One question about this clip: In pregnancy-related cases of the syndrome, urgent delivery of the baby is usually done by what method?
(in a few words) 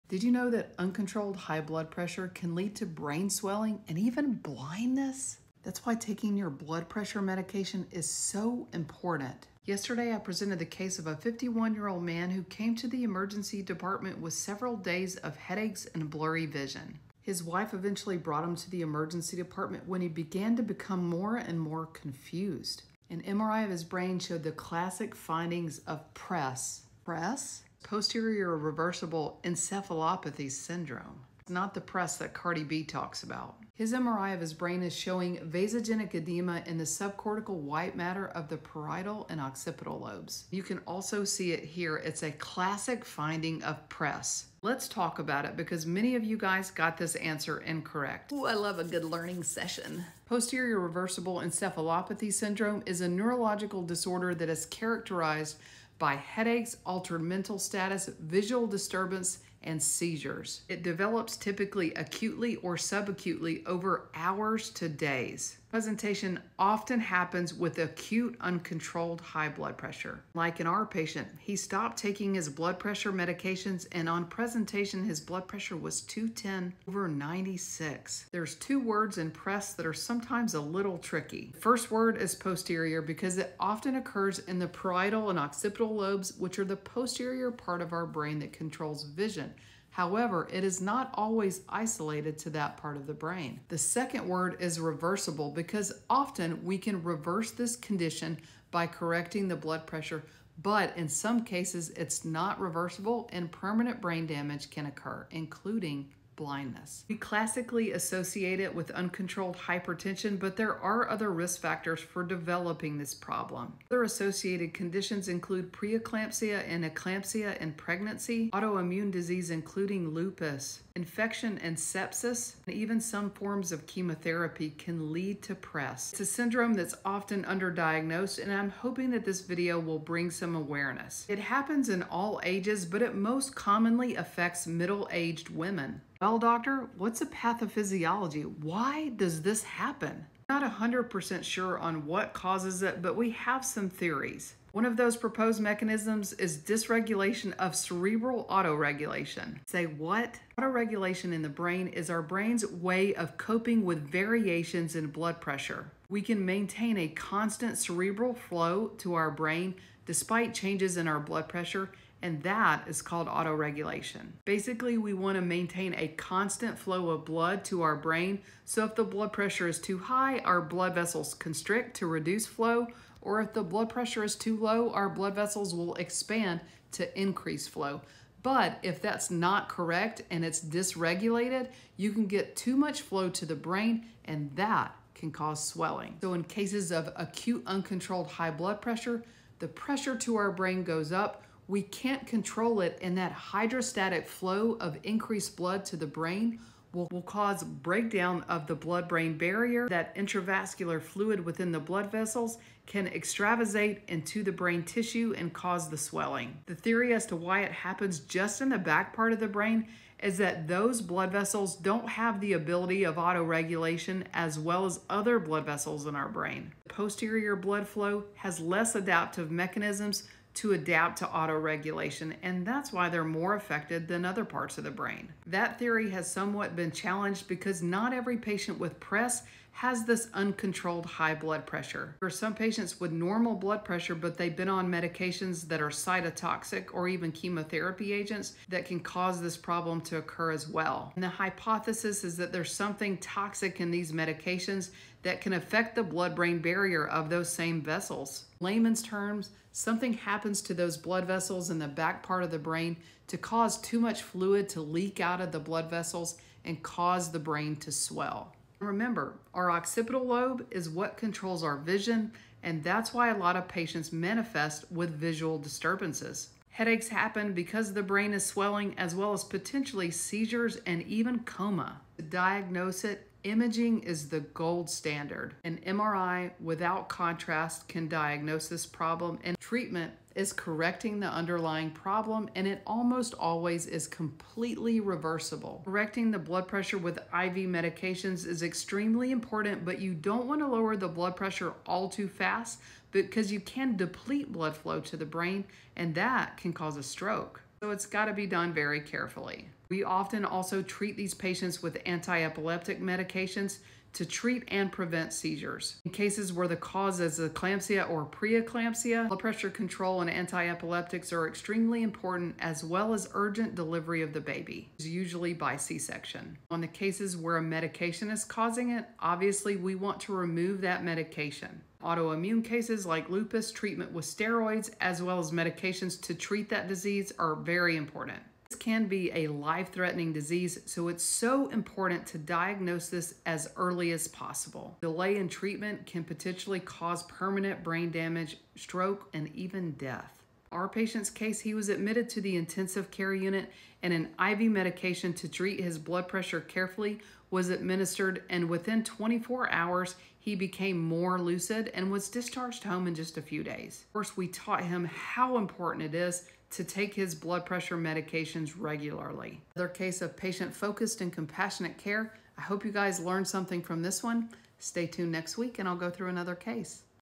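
C-section.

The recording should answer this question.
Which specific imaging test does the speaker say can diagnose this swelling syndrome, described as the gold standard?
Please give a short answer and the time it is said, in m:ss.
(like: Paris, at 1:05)
MRI without contrast, at 4:35.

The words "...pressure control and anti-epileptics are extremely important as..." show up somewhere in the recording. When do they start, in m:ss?
5:09.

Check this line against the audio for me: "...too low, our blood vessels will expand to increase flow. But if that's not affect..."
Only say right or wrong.
wrong.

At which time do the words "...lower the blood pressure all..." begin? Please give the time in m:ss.
4:50.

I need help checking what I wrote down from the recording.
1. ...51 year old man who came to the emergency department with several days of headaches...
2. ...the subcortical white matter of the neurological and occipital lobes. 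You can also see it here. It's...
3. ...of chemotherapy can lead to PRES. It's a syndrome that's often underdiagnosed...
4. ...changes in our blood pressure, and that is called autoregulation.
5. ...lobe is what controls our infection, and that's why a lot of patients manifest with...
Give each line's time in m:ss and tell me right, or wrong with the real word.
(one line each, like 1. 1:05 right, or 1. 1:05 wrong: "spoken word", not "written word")
1. 0:11 right
2. 0:36 wrong: "parietal", not "neurological"
3. 2:03 right
4. 2:40 right
5. 4:20 wrong: "vision", not "infection".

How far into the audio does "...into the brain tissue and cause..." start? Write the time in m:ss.
3:24.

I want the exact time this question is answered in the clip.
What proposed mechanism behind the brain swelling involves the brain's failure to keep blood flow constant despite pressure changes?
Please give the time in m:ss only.
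2:26.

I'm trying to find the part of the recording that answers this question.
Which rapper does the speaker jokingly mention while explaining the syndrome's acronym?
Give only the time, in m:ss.
0:32.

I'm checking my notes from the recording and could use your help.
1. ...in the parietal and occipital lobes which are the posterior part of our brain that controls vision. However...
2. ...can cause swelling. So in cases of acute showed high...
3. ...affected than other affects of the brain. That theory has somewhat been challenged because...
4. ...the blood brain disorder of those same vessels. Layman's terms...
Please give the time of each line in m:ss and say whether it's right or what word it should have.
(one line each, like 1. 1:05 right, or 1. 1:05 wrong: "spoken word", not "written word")
1. 1:24 right
2. 3:05 wrong: "uncontrolled", not "showed"
3. 3:43 wrong: "parts", not "affects"
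4. 4:05 wrong: "barrier", not "disorder".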